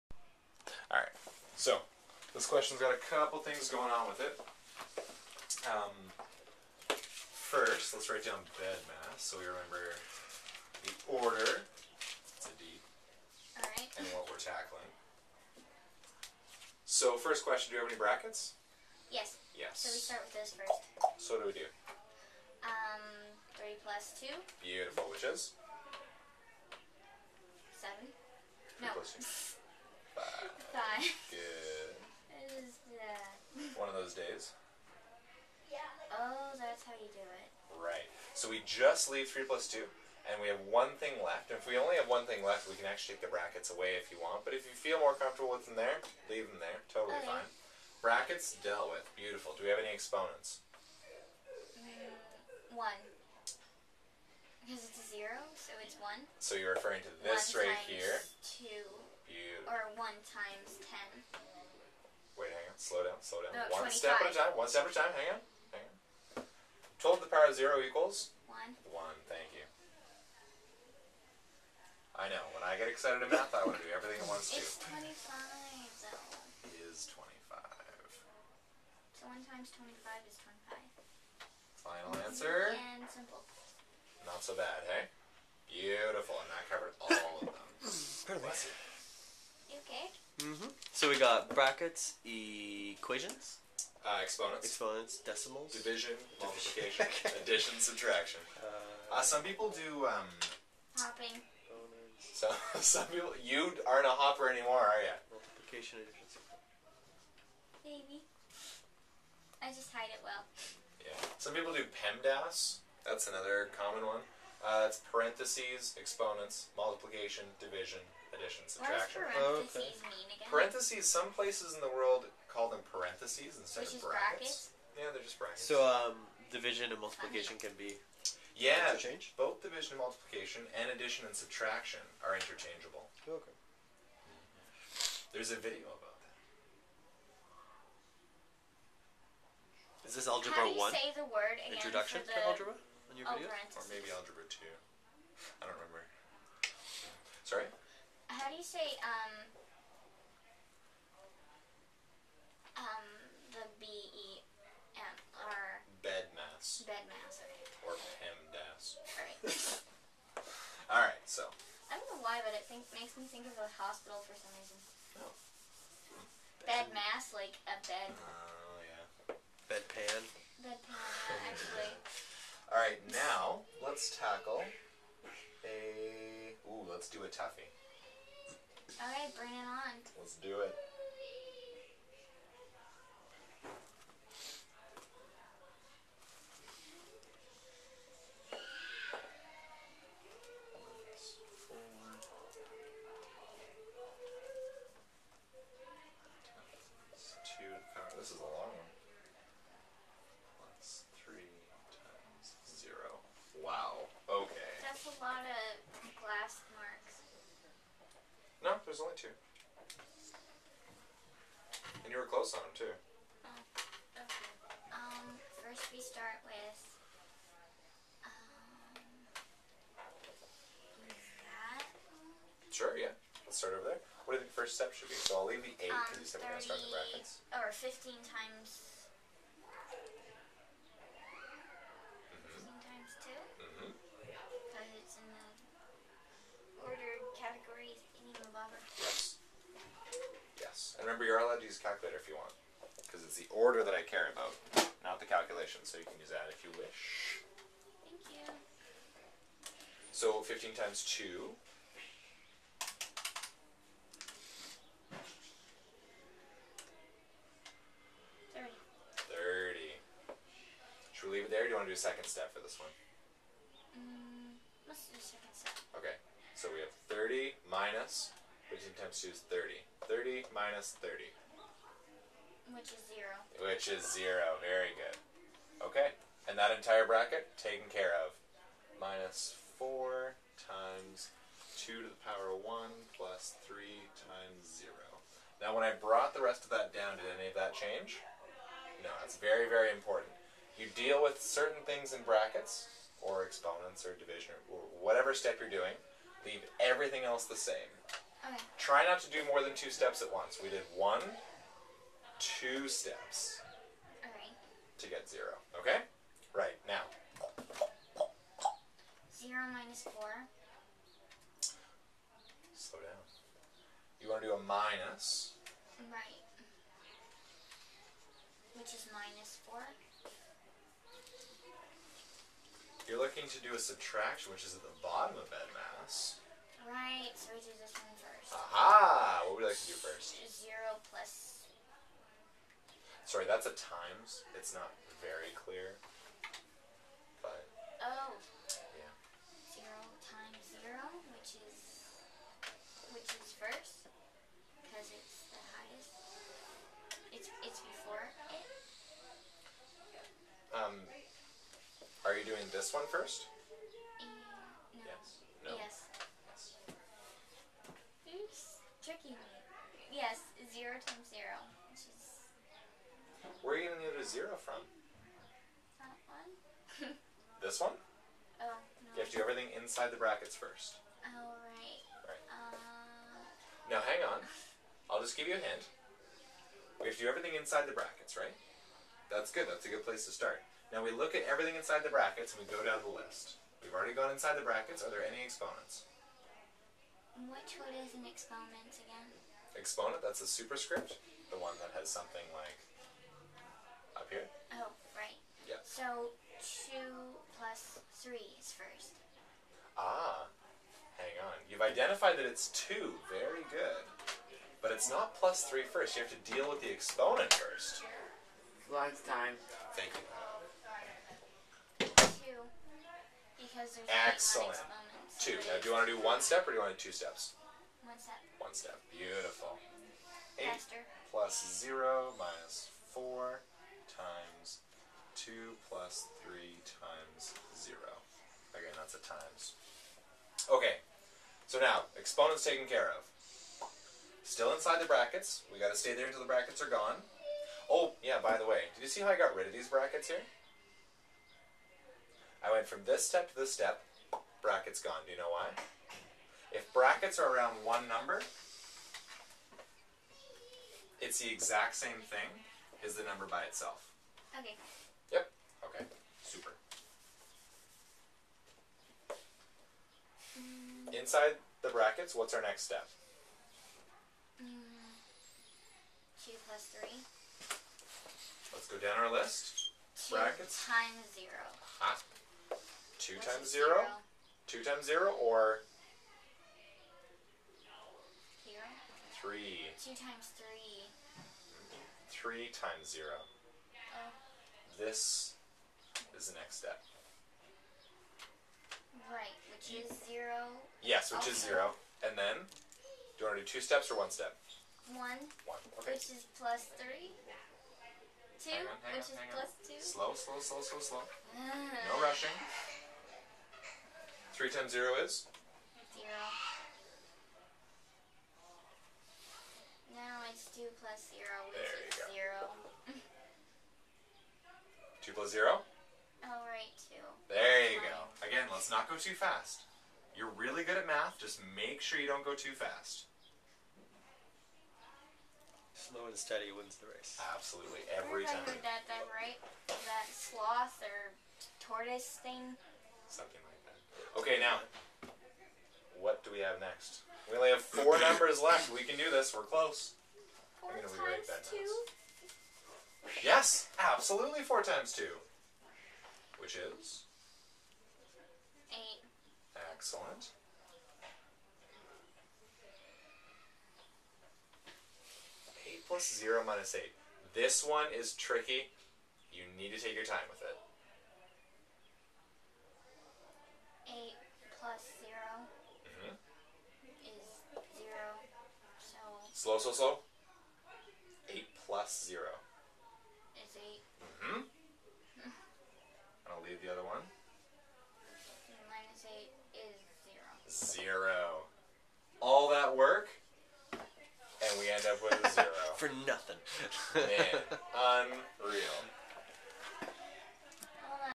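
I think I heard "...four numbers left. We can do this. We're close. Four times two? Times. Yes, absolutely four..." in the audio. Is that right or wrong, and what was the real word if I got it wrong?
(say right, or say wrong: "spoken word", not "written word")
right.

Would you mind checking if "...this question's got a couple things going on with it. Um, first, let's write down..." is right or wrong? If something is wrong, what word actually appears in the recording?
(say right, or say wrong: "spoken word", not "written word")
right.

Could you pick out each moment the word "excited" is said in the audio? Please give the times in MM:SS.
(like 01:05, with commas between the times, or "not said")
01:12.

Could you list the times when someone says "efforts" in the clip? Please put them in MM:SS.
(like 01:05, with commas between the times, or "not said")
not said.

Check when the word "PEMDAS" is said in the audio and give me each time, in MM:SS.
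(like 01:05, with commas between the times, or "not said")
01:51, 02:38.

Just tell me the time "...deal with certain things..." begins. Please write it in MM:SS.
04:50.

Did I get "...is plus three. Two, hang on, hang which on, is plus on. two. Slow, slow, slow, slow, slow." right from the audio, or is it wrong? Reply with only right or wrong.
right.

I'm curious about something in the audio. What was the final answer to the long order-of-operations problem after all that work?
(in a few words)
0.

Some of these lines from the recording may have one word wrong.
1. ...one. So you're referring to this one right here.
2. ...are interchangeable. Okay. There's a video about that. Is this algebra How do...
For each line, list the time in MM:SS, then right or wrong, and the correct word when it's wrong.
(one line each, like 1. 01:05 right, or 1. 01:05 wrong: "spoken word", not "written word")
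1. 00:56 right
2. 02:12 right.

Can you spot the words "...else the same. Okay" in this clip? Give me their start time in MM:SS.
04:57.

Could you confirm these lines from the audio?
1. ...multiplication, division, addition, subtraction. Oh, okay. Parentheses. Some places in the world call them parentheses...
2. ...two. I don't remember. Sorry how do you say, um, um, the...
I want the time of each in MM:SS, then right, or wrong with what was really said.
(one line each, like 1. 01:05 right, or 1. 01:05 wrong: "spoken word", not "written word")
1. 01:56 right
2. 02:24 right.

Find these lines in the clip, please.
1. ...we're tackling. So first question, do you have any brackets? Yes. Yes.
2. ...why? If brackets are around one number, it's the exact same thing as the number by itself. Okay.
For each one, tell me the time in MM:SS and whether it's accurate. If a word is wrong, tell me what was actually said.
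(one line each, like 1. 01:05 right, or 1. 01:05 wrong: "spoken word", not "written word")
1. 00:14 right
2. 07:25 right.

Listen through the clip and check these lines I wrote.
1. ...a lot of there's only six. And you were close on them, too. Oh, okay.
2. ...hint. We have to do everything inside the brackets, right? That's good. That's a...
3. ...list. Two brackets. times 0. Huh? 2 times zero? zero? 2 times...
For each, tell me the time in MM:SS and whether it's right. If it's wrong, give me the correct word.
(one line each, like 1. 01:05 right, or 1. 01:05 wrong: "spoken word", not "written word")
1. 03:25 wrong: "two", not "six"
2. 06:15 right
3. 07:49 right.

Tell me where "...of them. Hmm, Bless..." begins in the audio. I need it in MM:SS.
01:27.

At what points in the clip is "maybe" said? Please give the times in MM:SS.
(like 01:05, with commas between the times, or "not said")
01:47, 02:23.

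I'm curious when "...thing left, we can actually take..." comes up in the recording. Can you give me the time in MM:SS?
00:42.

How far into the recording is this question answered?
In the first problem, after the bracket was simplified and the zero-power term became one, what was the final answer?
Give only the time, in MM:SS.
01:19.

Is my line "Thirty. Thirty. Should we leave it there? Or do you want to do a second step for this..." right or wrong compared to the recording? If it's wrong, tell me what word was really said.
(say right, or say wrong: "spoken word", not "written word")
right.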